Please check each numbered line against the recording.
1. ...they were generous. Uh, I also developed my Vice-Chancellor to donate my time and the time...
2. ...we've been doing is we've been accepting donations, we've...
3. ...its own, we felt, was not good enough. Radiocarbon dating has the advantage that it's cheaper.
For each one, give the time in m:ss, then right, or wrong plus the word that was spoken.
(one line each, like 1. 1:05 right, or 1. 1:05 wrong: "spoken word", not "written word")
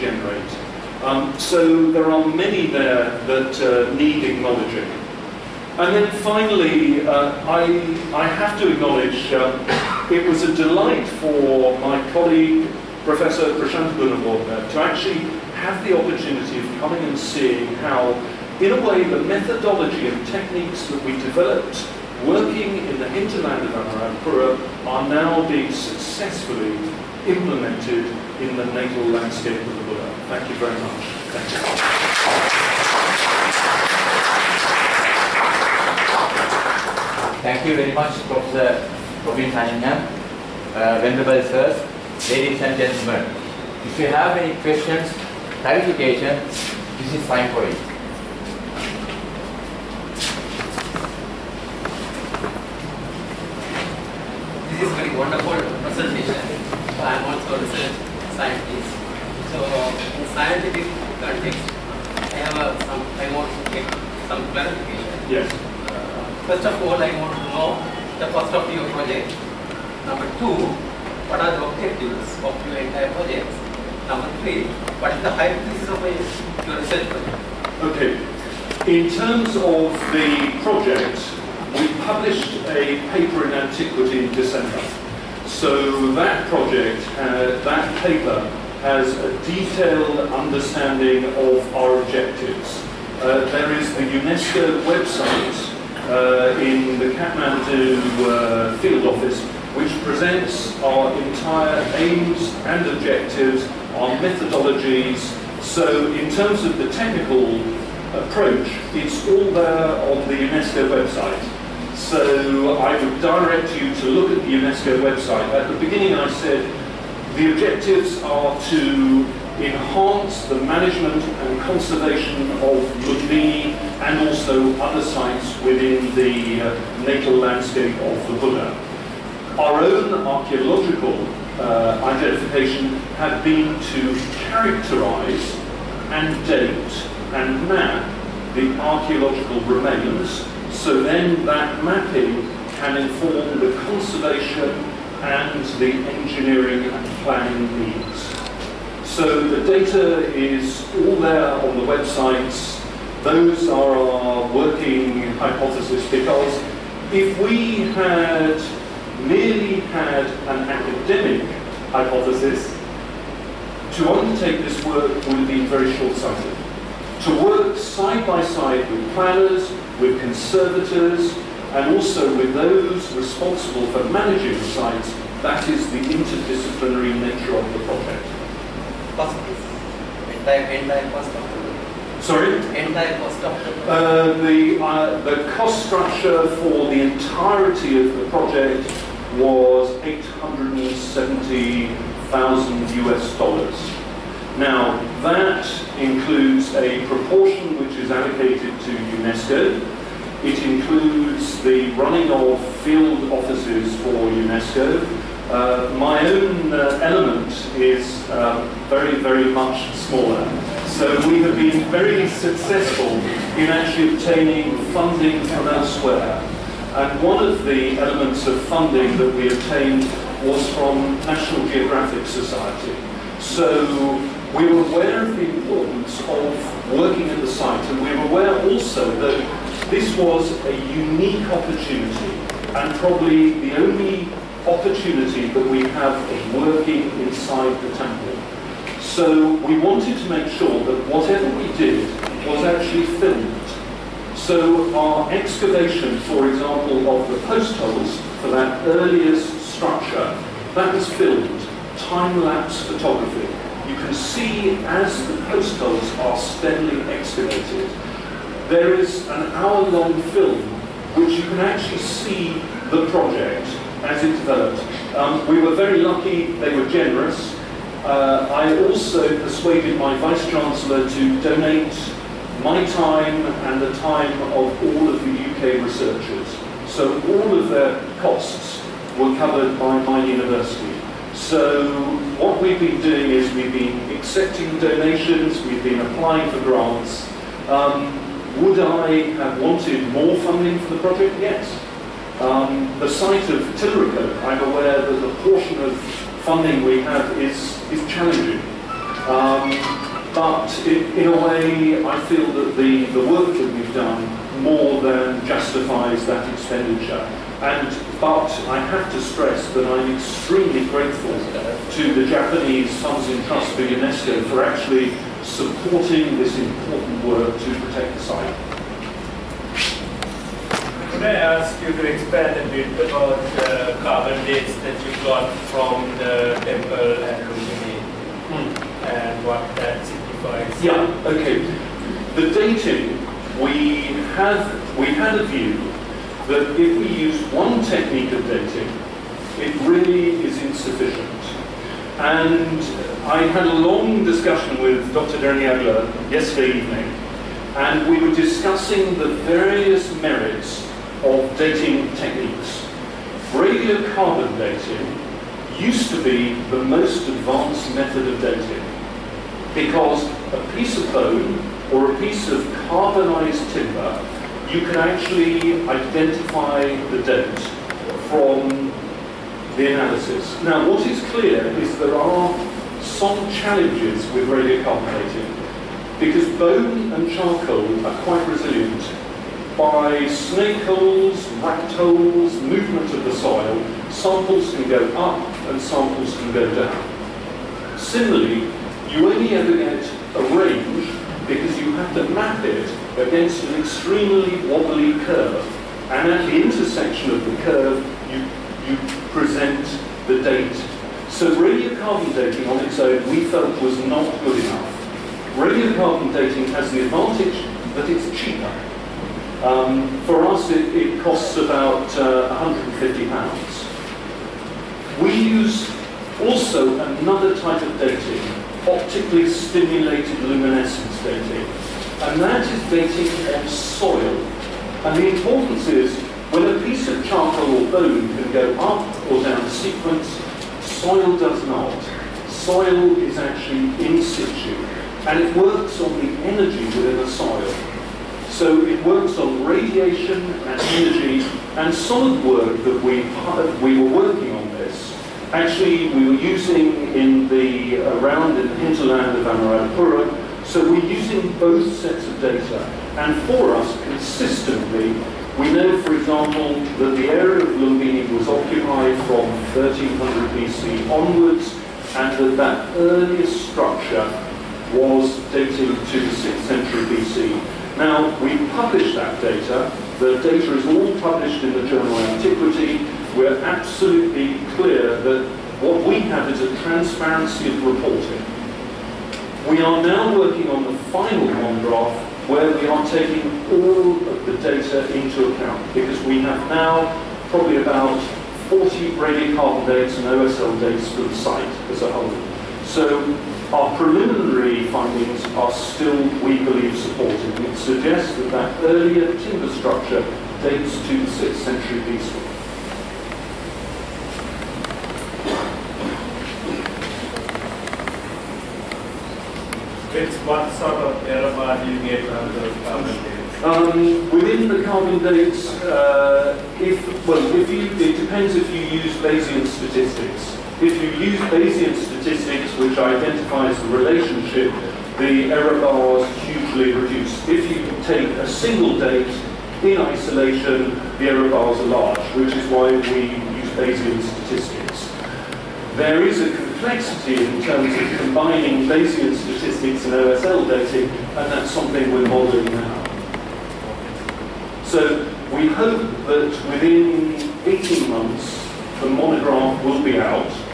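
1. 4:26 wrong: "persuaded", not "developed"
2. 4:42 right
3. 6:42 right.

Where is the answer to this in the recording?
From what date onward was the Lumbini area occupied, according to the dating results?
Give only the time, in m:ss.
7:39.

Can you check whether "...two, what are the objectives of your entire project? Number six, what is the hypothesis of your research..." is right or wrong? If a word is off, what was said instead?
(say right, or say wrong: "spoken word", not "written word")
wrong: "three", not "six".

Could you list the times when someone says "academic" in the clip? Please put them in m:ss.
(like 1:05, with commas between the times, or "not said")
2:40.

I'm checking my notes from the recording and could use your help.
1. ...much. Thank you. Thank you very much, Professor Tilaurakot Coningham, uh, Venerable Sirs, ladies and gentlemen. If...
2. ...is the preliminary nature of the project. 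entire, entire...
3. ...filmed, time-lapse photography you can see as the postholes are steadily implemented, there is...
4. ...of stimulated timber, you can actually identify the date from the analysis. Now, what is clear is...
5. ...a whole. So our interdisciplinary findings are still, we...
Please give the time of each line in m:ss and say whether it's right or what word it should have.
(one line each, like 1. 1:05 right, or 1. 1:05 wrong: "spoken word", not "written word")
1. 0:30 wrong: "Robin", not "Tilaurakot"
2. 2:55 wrong: "interdisciplinary", not "preliminary"
3. 4:11 wrong: "excavated", not "implemented"
4. 6:02 wrong: "carbonized", not "stimulated"
5. 8:12 wrong: "preliminary", not "interdisciplinary".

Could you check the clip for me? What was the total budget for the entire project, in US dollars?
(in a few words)
870,000 US dollars.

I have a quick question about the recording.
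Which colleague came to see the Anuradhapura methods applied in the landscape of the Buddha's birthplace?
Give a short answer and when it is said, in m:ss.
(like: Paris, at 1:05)
Prashant Gunawardhana, at 0:13.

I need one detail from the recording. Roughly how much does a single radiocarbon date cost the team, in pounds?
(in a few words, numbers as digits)
£150.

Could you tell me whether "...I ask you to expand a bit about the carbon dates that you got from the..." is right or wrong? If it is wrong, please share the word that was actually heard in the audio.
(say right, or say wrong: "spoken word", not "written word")
right.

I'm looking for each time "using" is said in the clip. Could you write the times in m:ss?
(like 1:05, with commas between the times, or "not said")
7:26, 7:31.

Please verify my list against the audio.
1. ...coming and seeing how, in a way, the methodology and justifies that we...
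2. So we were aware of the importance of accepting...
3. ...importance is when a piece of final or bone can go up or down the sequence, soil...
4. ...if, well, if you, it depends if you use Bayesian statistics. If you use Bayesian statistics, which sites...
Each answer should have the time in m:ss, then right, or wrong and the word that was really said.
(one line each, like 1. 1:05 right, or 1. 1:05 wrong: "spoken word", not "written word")
1. 0:16 wrong: "techniques", not "justifies"
2. 3:43 wrong: "working", not "accepting"
3. 7:05 wrong: "charcoal", not "final"
4. 8:36 wrong: "identifies", not "sites".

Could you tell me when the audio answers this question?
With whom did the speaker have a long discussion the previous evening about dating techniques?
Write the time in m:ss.
5:45.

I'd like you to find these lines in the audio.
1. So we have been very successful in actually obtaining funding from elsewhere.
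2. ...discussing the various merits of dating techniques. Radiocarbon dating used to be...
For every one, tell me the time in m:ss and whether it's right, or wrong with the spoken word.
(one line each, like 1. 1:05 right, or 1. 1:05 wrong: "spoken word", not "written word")
1. 3:30 right
2. 5:48 right.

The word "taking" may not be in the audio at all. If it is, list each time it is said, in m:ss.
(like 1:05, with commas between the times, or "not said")
8:03.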